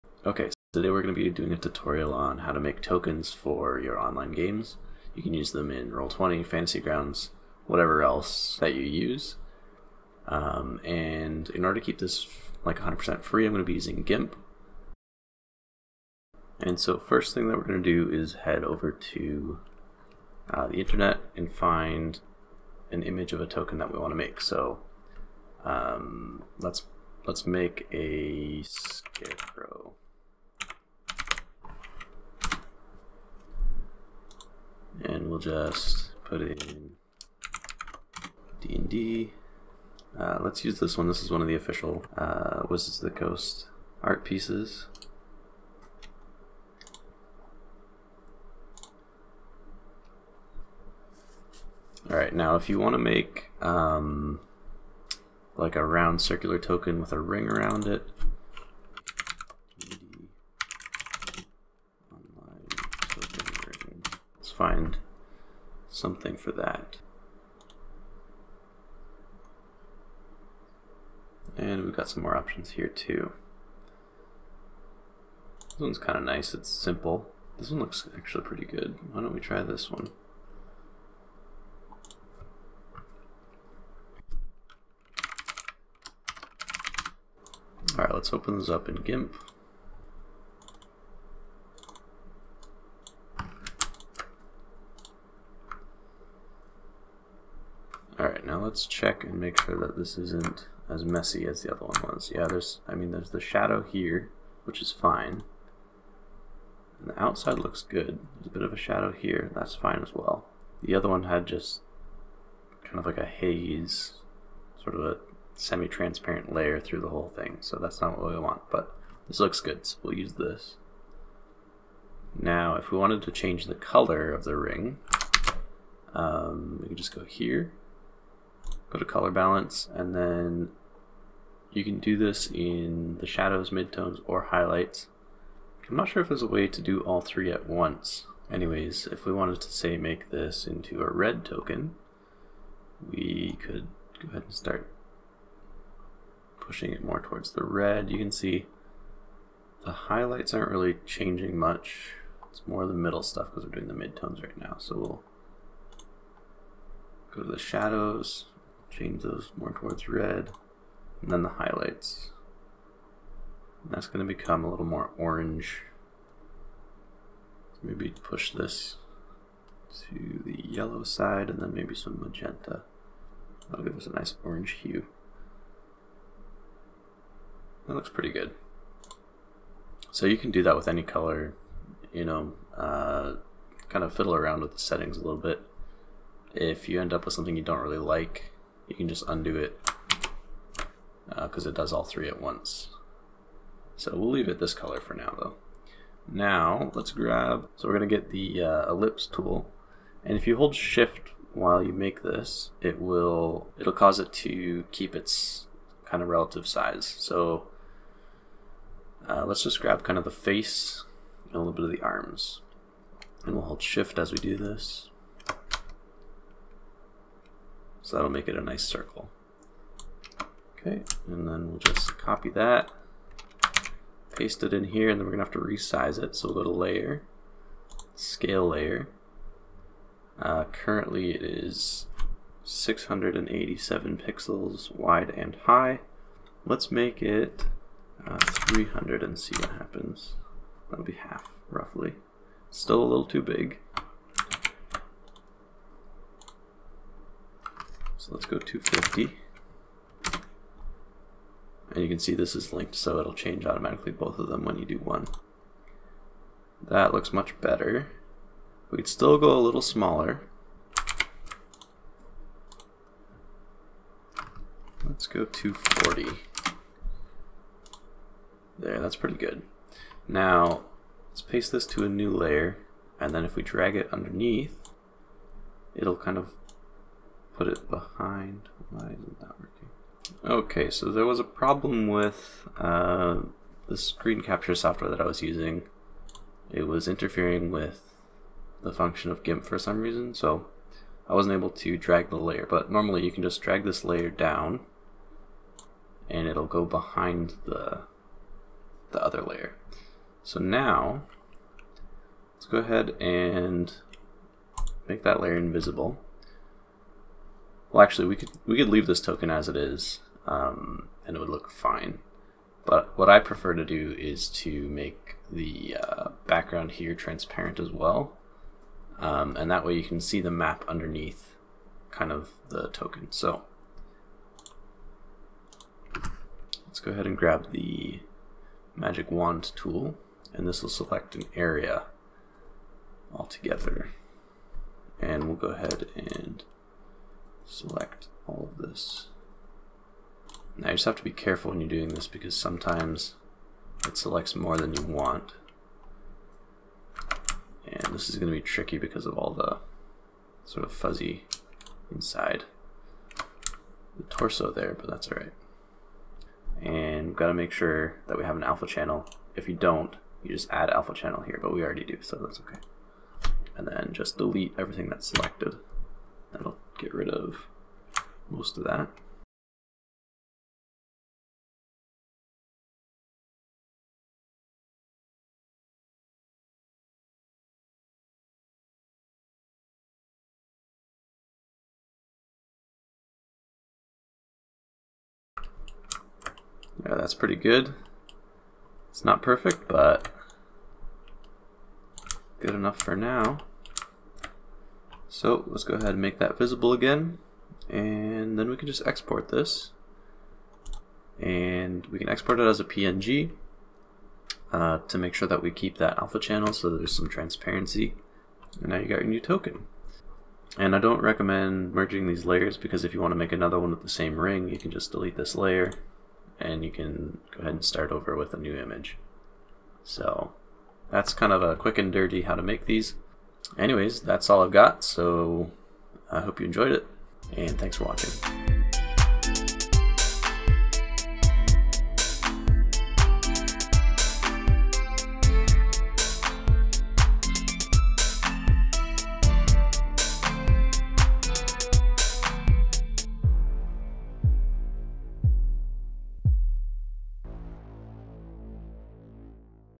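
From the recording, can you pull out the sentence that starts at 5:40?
Now you just have to be careful when you're doing this because sometimes it selects more than you want.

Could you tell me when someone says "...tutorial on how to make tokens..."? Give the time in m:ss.
0:01.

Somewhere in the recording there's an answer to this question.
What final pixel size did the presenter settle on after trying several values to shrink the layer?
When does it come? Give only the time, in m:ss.
4:25.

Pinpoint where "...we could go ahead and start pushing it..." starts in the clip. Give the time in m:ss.
2:23.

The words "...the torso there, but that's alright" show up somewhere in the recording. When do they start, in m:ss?
5:54.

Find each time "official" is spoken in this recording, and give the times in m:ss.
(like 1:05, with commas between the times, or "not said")
0:41.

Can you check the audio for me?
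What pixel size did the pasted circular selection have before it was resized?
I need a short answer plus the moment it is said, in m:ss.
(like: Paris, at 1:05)
687, at 3:52.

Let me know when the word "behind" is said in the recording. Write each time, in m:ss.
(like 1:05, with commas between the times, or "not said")
4:37, 4:56.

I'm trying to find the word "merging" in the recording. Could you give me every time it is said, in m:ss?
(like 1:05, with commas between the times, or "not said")
6:51.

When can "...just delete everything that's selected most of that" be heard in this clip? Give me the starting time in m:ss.
6:04.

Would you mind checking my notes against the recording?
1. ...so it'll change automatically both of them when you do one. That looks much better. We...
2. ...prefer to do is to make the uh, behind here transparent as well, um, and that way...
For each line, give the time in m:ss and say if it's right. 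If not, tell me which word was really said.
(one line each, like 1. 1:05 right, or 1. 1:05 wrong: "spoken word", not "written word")
1. 4:12 right
2. 5:13 wrong: "background", not "behind".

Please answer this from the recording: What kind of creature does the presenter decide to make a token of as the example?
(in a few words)
Scarecrow.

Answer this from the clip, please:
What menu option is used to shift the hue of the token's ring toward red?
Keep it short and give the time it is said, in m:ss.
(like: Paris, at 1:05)
Color balance, at 2:09.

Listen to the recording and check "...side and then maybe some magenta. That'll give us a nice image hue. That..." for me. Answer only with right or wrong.
wrong.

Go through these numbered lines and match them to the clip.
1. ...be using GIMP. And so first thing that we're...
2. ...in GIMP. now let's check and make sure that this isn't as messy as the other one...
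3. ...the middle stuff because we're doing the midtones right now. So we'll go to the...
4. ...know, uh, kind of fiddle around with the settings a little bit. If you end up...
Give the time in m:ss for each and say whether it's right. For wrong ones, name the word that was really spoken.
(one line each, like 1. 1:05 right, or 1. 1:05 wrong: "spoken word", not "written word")
1. 0:13 right
2. 1:28 right
3. 2:32 right
4. 3:02 right.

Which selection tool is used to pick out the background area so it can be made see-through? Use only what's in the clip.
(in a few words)
Magic wand tool.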